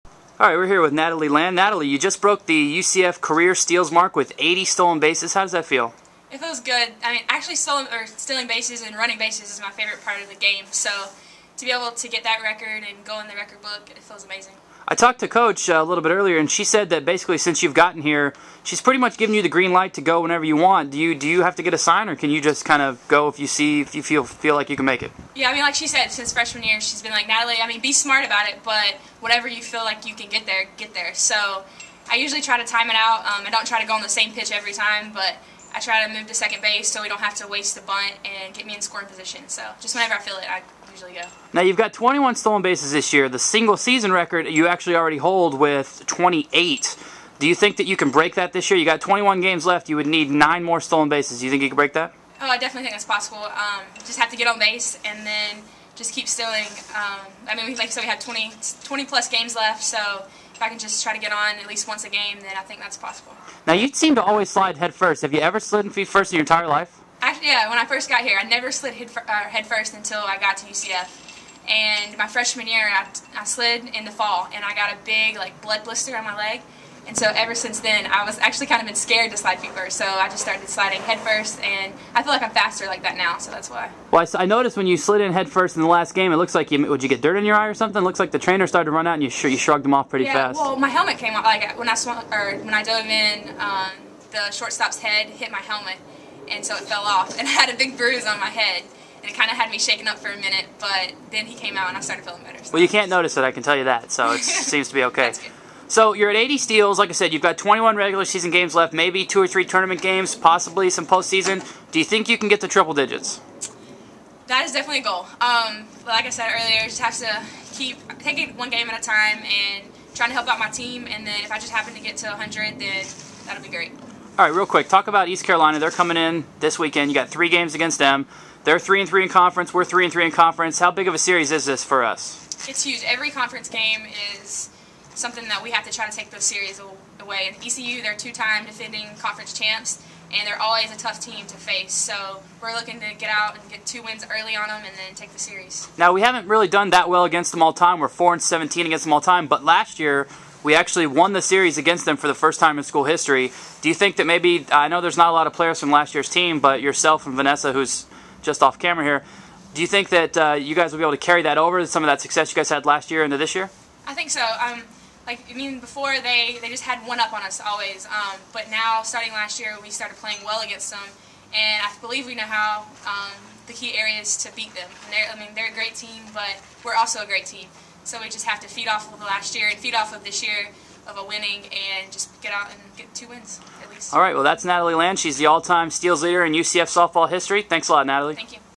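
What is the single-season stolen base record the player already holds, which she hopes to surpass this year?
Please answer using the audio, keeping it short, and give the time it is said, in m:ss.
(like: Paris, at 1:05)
28, at 0:46.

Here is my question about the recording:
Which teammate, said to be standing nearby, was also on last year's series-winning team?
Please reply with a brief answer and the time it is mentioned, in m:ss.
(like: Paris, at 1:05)
Vanessa, at 2:37.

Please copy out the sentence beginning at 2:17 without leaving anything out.
And ECU, they're two-time defending conference champs, and they're always a tough team to face.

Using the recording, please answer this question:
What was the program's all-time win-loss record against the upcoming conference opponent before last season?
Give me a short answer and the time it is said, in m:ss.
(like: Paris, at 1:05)
4 and 17, at 2:28.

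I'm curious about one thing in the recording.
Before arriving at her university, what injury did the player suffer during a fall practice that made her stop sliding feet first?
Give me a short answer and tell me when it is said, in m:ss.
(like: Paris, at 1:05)
blood blister, at 1:15.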